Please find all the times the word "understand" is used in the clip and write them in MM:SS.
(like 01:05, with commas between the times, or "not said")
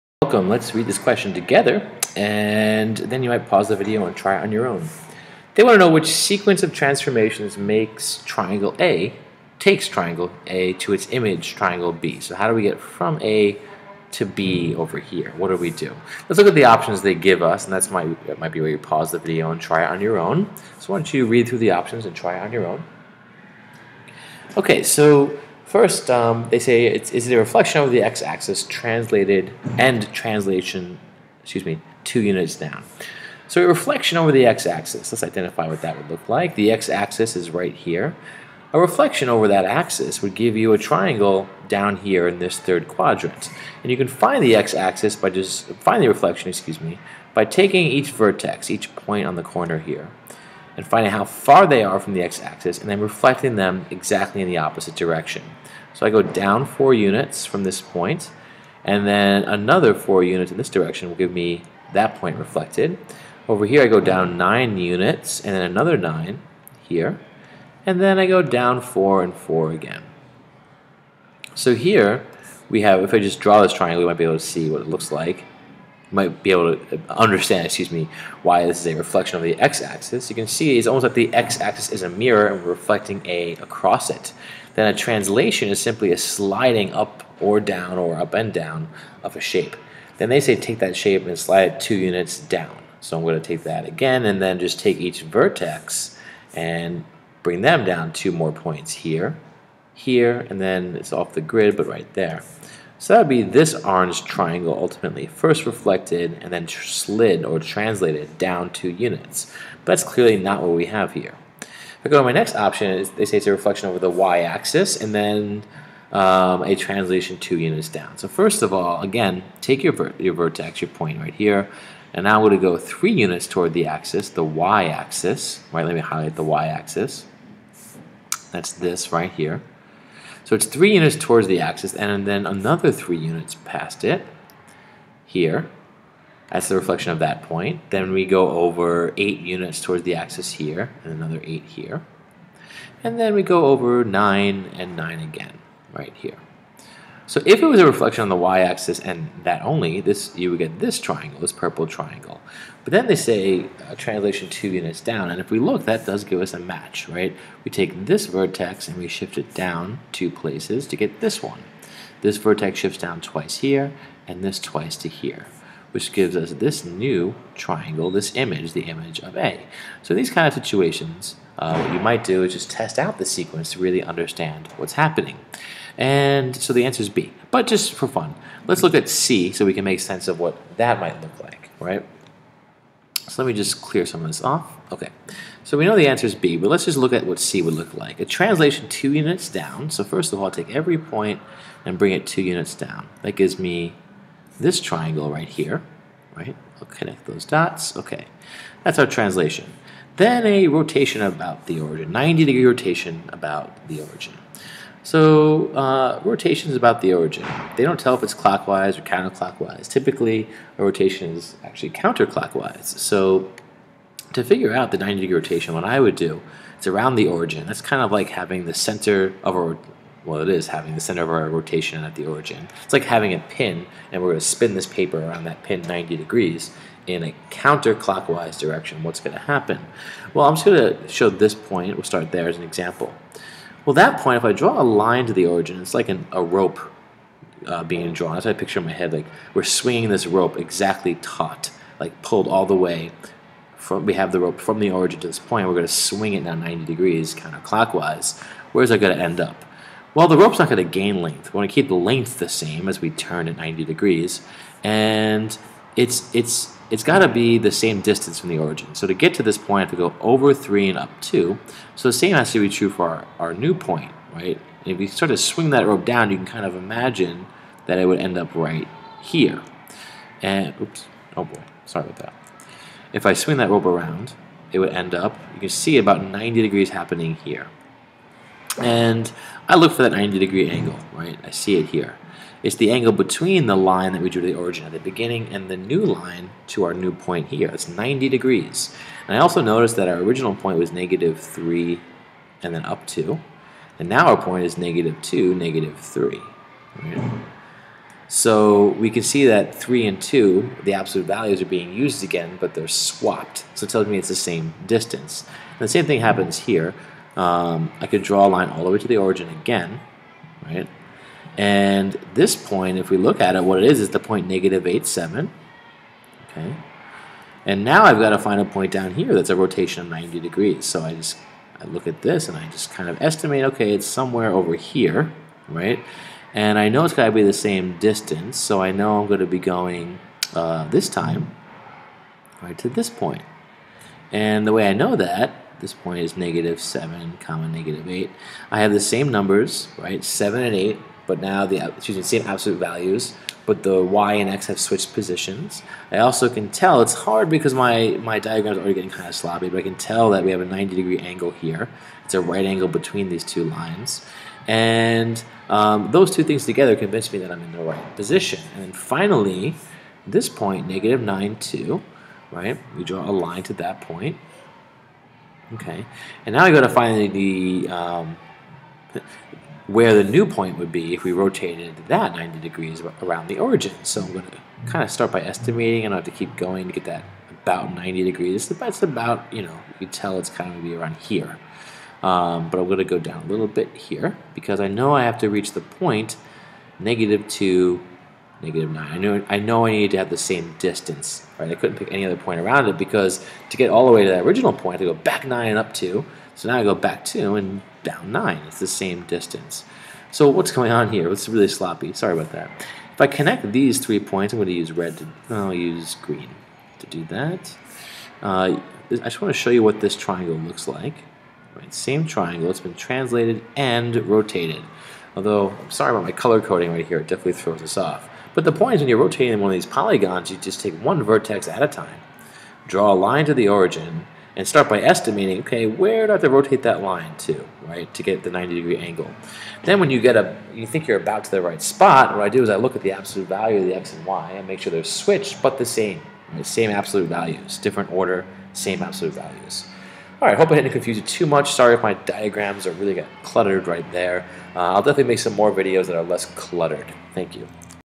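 01:17, 02:54.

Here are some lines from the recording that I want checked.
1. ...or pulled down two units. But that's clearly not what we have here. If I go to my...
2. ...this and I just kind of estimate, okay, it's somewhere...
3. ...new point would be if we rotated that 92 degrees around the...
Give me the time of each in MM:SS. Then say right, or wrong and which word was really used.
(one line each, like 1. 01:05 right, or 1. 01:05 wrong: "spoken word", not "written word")
1. 01:47 wrong: "translated", not "pulled"
2. 05:22 right
3. 06:10 wrong: "90", not "92".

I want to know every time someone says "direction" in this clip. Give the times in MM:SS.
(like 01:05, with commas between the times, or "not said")
00:54, 01:00, 03:48.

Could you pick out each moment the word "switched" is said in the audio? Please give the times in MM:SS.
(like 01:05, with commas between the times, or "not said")
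05:44, 07:15.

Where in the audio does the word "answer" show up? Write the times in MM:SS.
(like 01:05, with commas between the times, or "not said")
02:56, 03:06.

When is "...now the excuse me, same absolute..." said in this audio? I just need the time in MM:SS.
05:41.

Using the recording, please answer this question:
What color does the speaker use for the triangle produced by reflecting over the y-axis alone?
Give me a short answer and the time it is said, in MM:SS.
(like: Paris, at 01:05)
purple, at 02:31.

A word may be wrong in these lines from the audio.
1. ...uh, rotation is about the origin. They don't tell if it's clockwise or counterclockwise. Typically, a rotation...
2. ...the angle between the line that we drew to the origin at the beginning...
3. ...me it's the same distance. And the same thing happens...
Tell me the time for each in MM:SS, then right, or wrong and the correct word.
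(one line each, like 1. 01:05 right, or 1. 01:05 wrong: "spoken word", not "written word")
1. 03:25 right
2. 04:42 right
3. 05:04 right.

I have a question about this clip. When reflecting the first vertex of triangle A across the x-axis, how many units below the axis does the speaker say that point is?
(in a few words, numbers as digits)
4.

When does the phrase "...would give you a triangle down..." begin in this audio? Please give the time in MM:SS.
00:40.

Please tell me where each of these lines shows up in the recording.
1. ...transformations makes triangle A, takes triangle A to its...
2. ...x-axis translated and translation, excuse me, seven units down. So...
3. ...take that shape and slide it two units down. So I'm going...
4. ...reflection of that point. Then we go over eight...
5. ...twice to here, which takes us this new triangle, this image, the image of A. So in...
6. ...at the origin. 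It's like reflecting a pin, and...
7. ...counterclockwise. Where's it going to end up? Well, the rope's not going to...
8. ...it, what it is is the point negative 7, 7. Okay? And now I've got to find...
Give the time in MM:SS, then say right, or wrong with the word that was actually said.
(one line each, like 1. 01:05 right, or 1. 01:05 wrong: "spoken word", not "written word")
1. 00:06 right
2. 00:28 wrong: "two", not "seven"
3. 01:30 right
4. 02:16 right
5. 02:44 wrong: "gives", not "takes"
6. 03:42 wrong: "having", not "reflecting"
7. 04:07 right
8. 05:13 wrong: "8", not "7".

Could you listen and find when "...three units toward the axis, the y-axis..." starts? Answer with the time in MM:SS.
02:02.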